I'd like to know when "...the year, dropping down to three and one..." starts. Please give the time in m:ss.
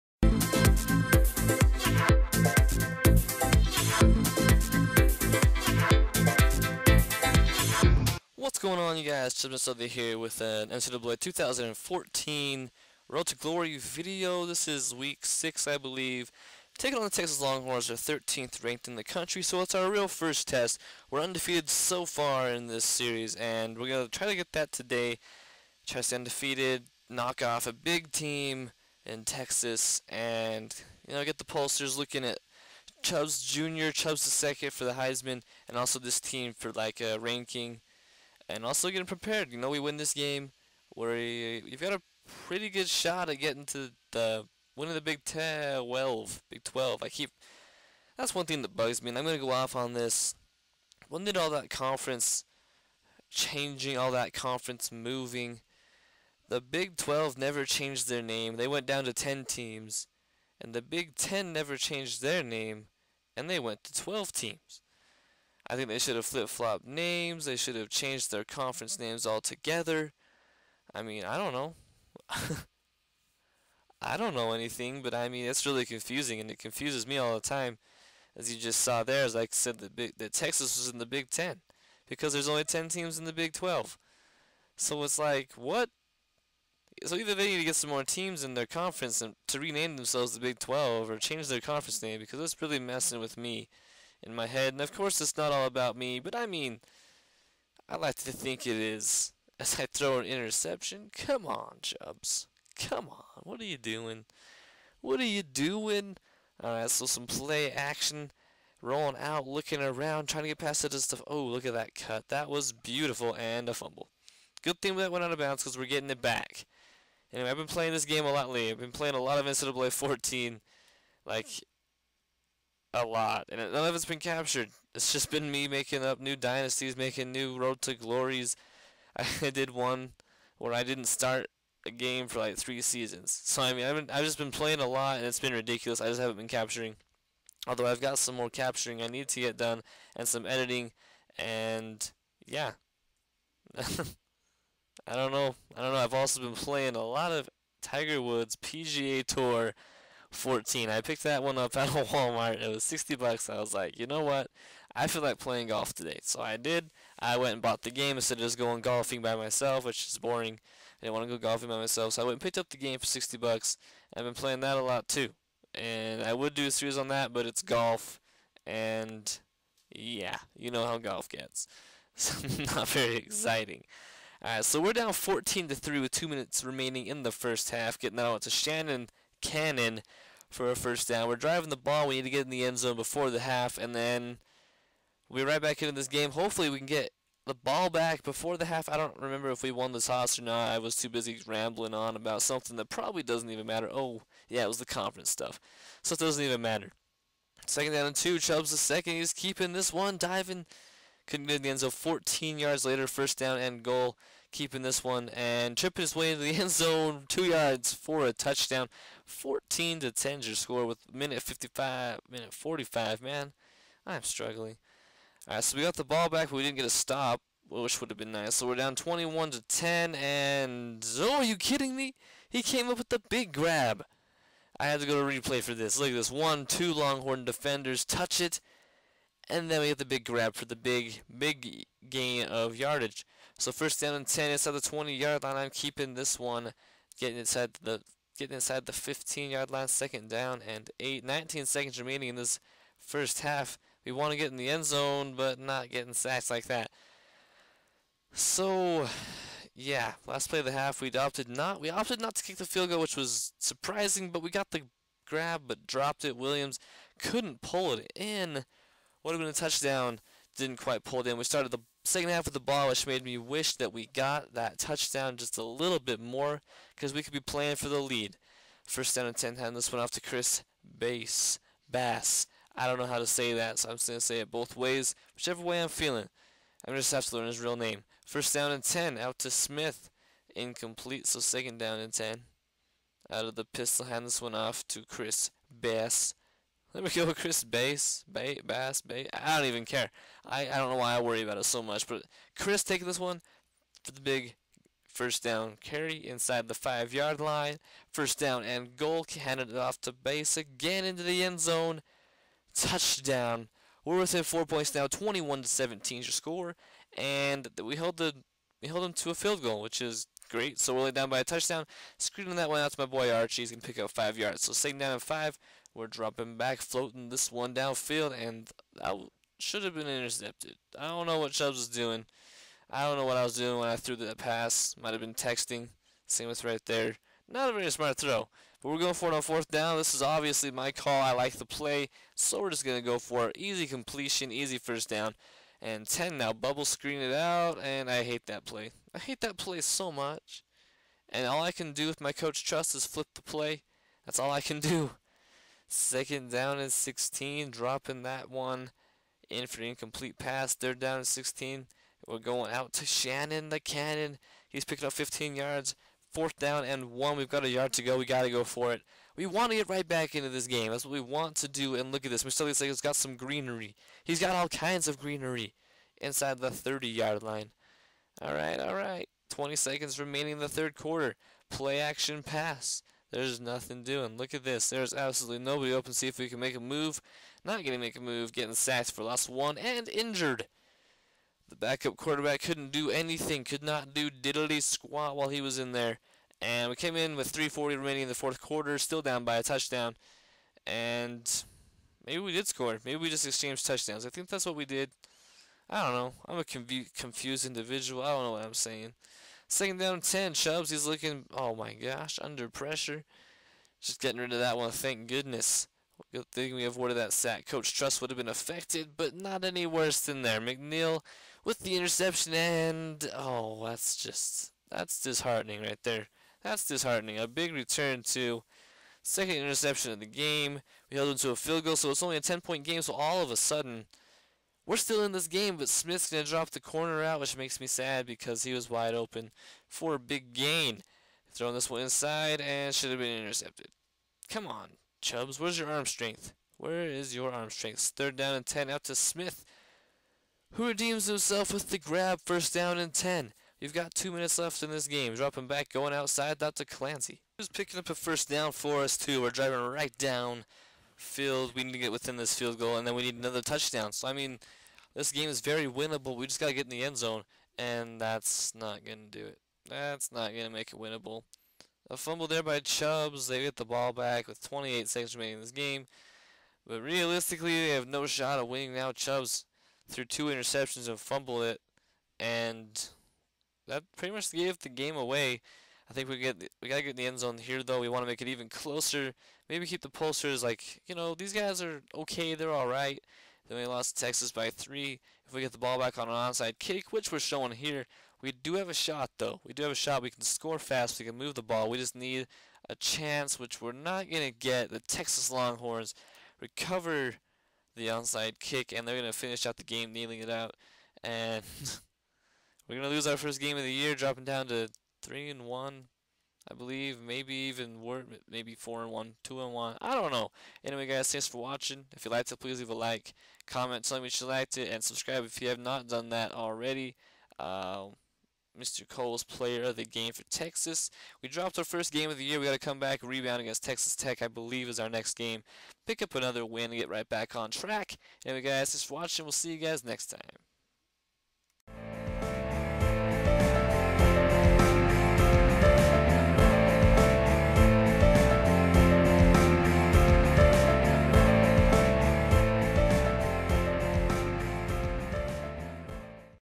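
8:23.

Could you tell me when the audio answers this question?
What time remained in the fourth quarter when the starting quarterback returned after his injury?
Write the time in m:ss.
6:27.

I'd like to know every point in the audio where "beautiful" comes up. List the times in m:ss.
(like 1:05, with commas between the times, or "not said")
1:52.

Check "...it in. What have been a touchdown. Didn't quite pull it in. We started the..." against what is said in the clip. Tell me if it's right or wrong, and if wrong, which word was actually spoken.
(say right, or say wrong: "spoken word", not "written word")
right.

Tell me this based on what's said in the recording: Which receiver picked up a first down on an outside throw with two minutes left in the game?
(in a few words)
Clancy.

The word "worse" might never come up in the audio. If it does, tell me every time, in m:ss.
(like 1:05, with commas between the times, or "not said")
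6:49.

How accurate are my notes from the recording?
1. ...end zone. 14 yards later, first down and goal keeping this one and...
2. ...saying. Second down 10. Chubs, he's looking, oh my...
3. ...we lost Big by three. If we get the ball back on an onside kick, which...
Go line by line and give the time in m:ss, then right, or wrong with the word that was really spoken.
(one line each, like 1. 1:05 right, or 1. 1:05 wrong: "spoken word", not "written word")
1. 3:21 right
2. 6:38 right
3. 8:03 wrong: "Texas", not "Big".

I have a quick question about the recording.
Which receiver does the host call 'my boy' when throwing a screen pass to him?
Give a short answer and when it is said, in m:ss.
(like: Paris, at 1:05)
Archie, at 5:13.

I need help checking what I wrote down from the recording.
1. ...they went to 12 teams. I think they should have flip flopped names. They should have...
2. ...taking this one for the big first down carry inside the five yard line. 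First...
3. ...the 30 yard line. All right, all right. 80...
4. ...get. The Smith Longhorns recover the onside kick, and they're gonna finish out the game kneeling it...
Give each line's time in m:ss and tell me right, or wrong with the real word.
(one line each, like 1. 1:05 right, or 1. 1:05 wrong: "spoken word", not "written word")
1. 1:03 right
2. 4:52 right
3. 6:06 wrong: "20", not "80"
4. 8:14 wrong: "Texas", not "Smith".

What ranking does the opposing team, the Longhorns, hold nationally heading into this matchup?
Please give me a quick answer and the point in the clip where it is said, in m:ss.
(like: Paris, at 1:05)
13th, at 0:18.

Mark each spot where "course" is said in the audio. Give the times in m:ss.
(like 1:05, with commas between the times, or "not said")
1:34.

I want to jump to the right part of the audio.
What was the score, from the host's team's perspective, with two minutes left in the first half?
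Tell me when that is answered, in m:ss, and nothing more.
2:55.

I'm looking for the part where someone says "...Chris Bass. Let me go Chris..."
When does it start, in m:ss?
4:45.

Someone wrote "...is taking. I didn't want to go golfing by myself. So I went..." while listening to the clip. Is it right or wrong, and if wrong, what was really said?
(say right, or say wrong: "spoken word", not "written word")
wrong: "boring", not "taking".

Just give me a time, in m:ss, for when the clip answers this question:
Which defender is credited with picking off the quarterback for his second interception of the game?
6:50.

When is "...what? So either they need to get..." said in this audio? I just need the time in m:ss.
1:25.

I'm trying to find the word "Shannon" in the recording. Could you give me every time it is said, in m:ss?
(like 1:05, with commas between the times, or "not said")
2:58, 5:53.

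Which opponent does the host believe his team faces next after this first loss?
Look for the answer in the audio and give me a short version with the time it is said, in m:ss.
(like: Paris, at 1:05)
Texas Tech, at 8:43.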